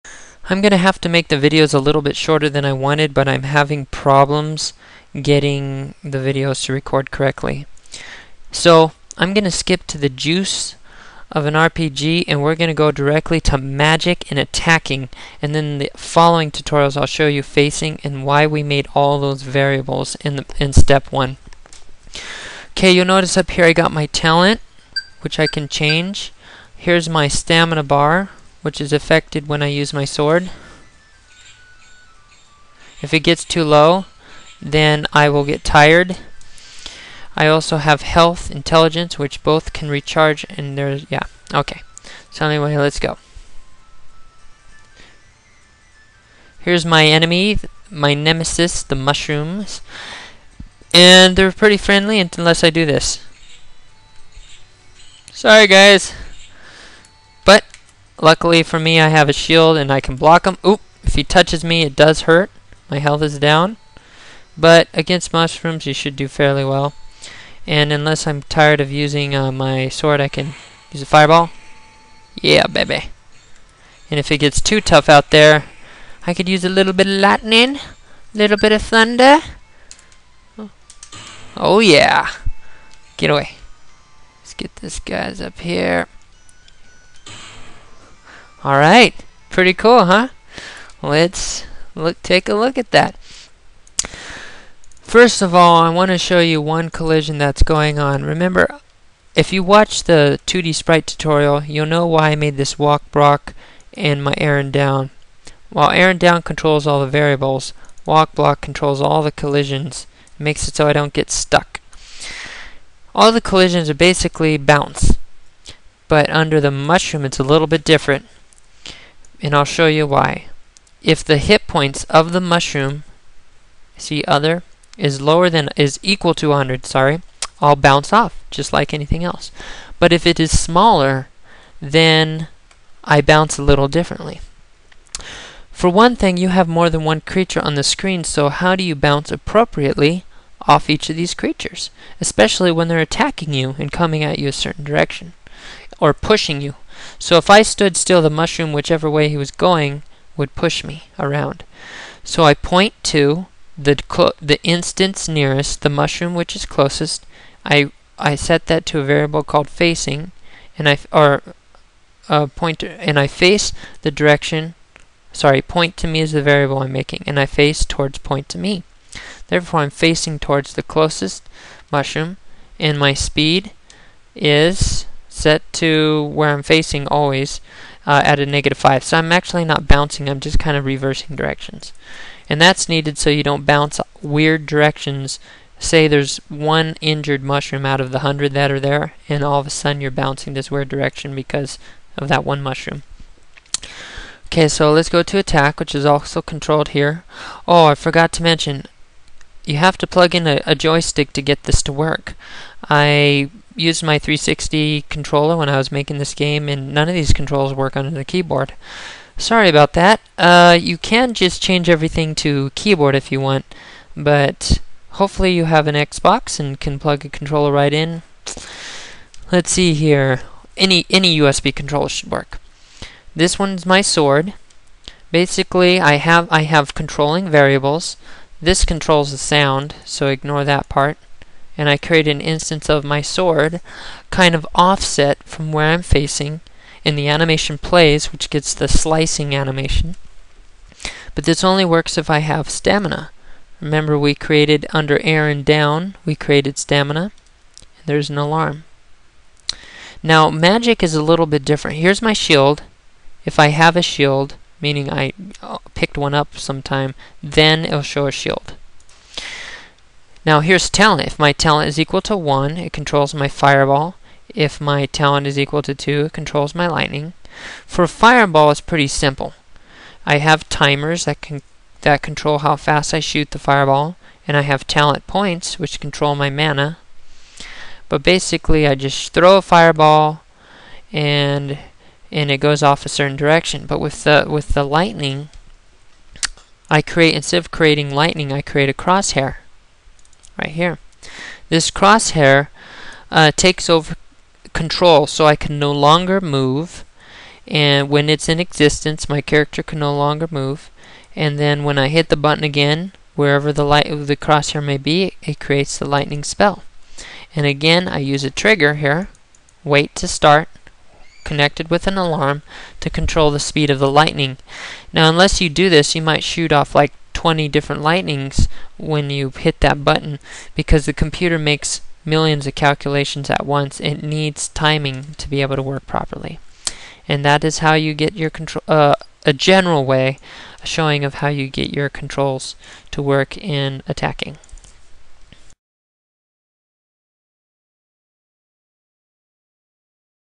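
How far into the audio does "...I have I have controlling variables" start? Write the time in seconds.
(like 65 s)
225 s.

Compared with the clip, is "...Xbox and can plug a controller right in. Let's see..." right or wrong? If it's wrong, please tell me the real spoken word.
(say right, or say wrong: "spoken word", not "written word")
right.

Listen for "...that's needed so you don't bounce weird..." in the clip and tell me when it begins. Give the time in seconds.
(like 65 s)
182 s.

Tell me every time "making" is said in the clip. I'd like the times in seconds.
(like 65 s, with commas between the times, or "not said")
166 s, 205 s.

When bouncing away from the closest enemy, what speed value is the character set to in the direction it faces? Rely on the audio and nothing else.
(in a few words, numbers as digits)
-5.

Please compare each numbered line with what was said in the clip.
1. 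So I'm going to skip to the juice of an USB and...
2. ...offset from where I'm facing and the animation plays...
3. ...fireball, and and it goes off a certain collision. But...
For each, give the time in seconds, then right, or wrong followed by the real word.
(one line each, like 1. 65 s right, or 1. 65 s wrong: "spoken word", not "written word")
1. 8 s wrong: "RPG", not "USB"
2. 234 s right
3. 279 s wrong: "direction", not "collision".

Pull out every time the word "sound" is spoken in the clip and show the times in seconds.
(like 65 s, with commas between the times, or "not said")
229 s.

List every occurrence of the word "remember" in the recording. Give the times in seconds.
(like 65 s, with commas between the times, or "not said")
98 s, 243 s.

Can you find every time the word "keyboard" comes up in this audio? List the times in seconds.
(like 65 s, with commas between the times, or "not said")
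208 s, 212 s.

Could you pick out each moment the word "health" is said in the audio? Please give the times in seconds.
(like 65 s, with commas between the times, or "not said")
38 s, 62 s.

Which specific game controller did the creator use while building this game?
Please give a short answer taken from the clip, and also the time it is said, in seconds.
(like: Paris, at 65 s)
360 controller, at 204 s.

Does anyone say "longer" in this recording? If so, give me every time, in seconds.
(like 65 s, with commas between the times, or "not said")
295 s, 300 s.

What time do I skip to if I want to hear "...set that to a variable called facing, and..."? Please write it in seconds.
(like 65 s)
158 s.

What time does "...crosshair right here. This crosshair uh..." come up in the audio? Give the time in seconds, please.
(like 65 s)
288 s.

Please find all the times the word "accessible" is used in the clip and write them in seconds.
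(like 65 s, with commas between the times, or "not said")
not said.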